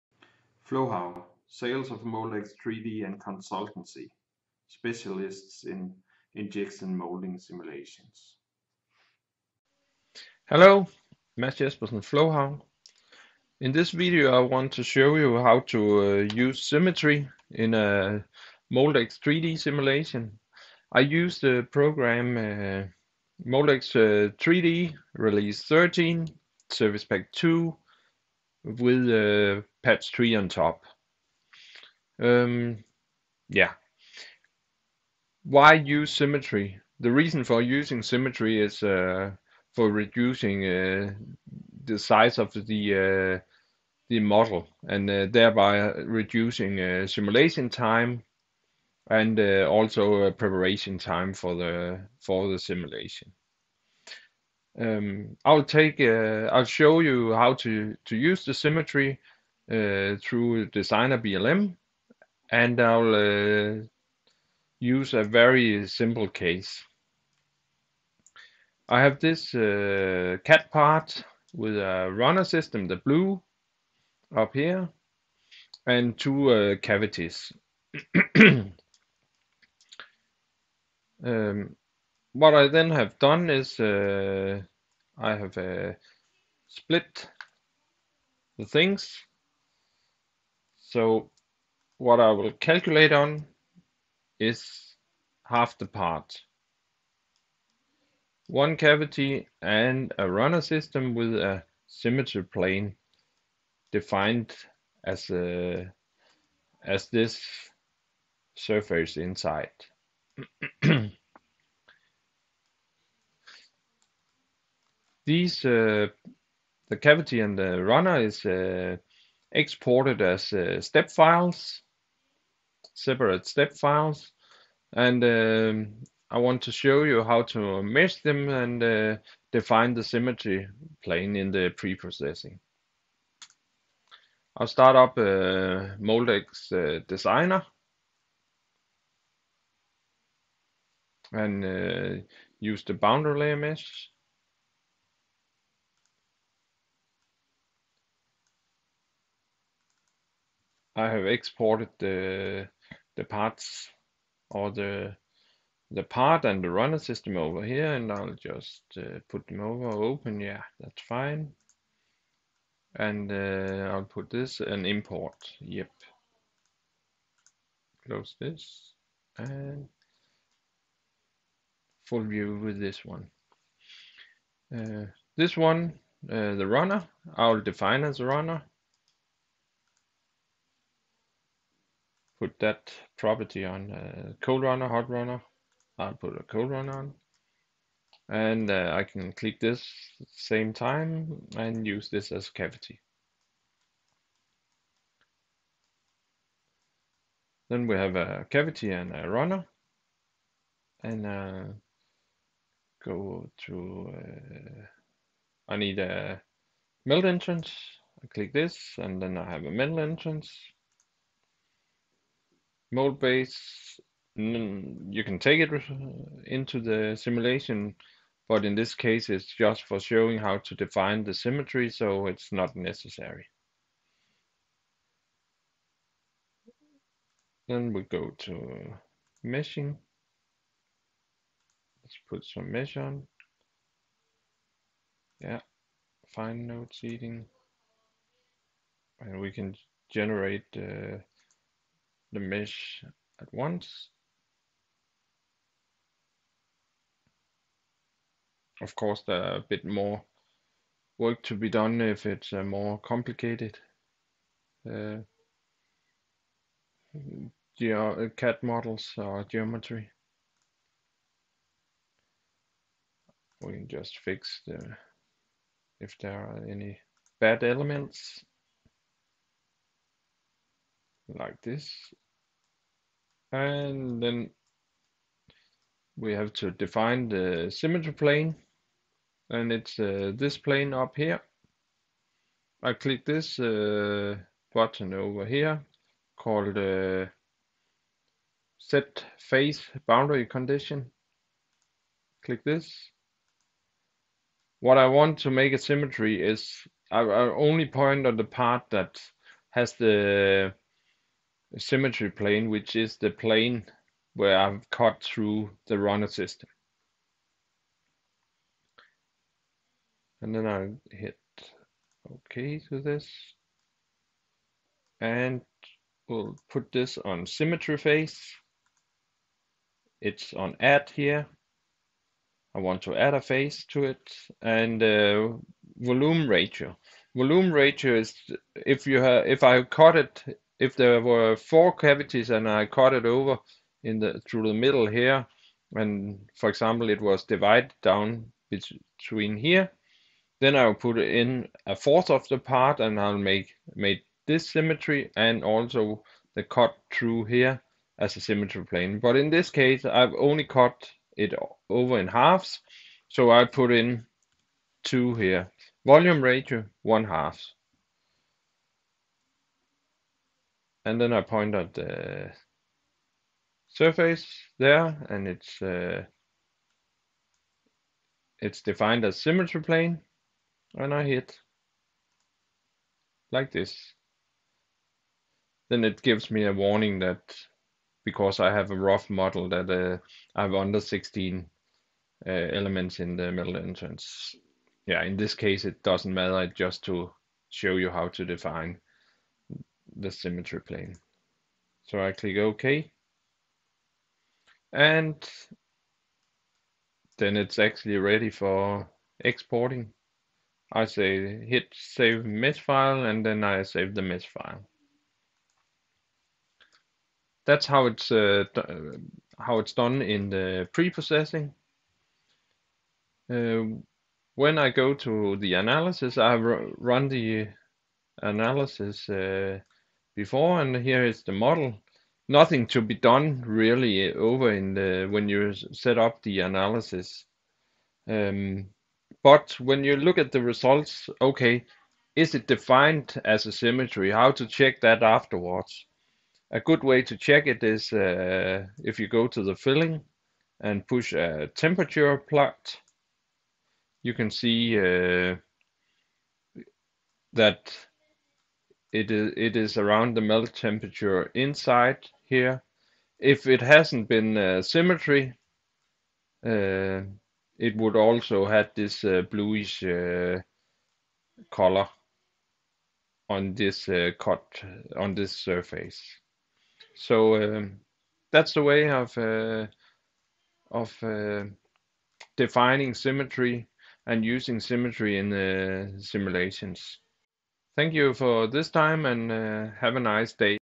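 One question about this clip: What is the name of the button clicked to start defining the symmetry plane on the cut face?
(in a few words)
set face boundary condition.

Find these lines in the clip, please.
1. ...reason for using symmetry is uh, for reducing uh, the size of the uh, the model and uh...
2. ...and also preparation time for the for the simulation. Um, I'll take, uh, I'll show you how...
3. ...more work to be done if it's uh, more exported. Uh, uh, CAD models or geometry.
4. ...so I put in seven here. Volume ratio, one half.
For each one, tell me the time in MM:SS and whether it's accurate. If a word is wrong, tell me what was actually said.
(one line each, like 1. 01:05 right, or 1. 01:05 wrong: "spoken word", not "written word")
1. 00:37 right
2. 00:49 right
3. 04:09 wrong: "complicated", not "exported"
4. 05:53 wrong: "two", not "seven".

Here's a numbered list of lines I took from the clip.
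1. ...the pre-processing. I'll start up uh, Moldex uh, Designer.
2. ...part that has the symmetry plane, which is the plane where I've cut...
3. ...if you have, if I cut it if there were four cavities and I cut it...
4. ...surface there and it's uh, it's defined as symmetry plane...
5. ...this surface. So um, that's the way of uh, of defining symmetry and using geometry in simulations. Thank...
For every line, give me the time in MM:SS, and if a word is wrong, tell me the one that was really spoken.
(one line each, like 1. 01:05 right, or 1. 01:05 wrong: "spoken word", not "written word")
1. 02:11 right
2. 04:58 right
3. 05:28 right
4. 06:03 right
5. 07:45 wrong: "symmetry", not "geometry".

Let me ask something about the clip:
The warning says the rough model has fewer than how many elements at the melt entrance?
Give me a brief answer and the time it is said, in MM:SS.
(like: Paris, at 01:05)
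16, at 06:21.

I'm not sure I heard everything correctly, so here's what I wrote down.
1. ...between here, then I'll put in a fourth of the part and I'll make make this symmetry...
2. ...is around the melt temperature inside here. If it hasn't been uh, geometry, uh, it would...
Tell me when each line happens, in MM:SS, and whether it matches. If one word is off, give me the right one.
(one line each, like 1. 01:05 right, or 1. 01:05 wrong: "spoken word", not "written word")
1. 05:38 right
2. 07:29 wrong: "symmetry", not "geometry".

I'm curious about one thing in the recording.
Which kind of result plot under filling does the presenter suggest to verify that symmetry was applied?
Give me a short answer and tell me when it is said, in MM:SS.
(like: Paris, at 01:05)
temperature plot, at 07:21.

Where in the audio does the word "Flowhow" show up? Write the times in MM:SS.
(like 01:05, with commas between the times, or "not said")
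00:00, 00:12.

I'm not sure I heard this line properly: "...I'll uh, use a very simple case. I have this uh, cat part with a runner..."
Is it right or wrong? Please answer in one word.
right.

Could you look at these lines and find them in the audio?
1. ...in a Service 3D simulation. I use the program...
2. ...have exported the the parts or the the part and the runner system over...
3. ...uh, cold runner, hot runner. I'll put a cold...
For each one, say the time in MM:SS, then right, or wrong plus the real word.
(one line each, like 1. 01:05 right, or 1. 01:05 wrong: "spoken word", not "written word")
1. 00:17 wrong: "Moldex", not "Service"
2. 02:31 right
3. 03:03 right.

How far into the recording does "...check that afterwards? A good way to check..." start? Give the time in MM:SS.
07:14.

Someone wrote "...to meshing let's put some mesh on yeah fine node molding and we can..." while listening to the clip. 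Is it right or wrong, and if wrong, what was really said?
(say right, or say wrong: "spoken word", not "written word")
wrong: "seeding", not "molding".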